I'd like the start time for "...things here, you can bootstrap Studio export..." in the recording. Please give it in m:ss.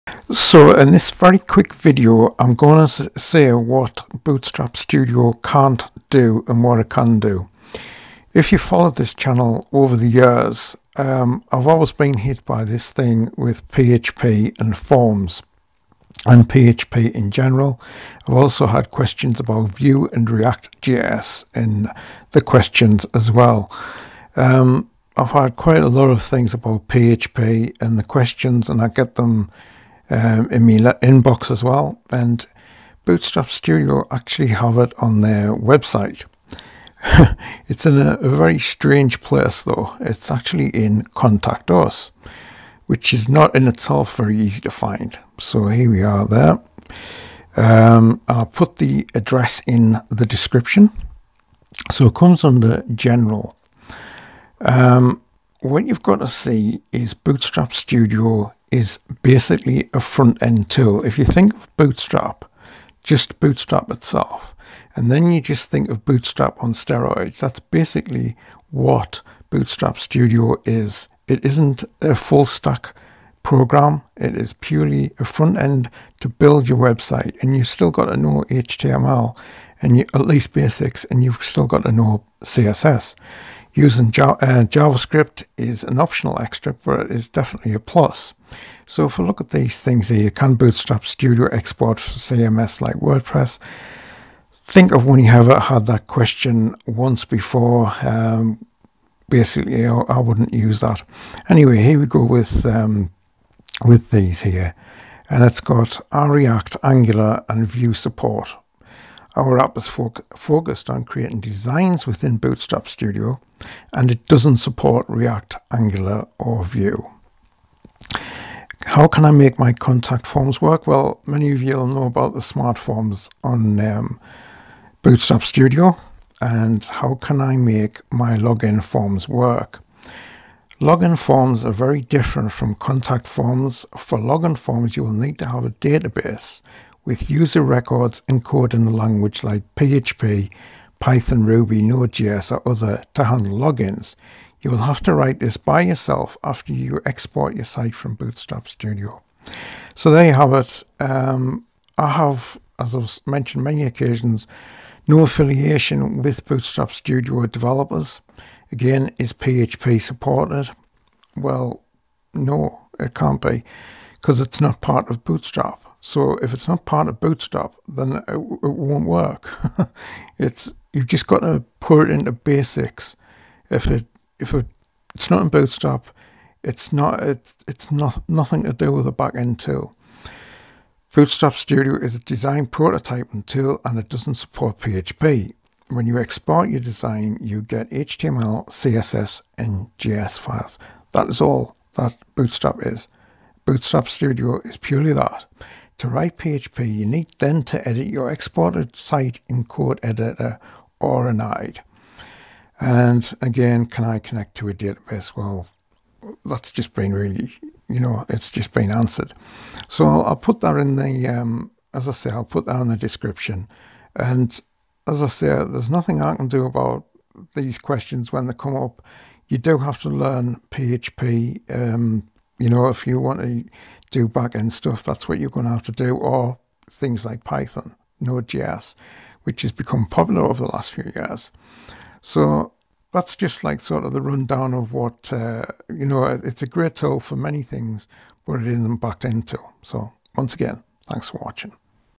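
1:29.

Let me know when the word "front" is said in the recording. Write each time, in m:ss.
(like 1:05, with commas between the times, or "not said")
0:59, 1:15.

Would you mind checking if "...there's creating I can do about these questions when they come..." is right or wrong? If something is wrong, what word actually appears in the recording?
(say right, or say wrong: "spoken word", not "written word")
wrong: "nothing", not "creating".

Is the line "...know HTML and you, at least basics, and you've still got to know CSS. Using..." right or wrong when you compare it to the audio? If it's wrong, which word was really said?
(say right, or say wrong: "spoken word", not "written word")
right.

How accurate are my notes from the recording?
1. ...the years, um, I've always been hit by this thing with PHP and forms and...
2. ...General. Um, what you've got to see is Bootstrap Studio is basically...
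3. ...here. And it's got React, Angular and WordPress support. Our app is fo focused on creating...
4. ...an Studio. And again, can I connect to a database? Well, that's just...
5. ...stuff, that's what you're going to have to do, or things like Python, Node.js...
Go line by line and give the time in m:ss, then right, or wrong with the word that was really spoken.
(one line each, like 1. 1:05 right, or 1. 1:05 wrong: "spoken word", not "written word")
1. 0:09 right
2. 0:52 right
3. 1:44 wrong: "Vue", not "WordPress"
4. 3:21 wrong: "IDE", not "Studio"
5. 3:44 right.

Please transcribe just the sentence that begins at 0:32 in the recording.
And Bootstrap Studio actually have it on their website.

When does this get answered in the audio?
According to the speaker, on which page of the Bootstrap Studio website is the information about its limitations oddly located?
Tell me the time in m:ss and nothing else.
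0:41.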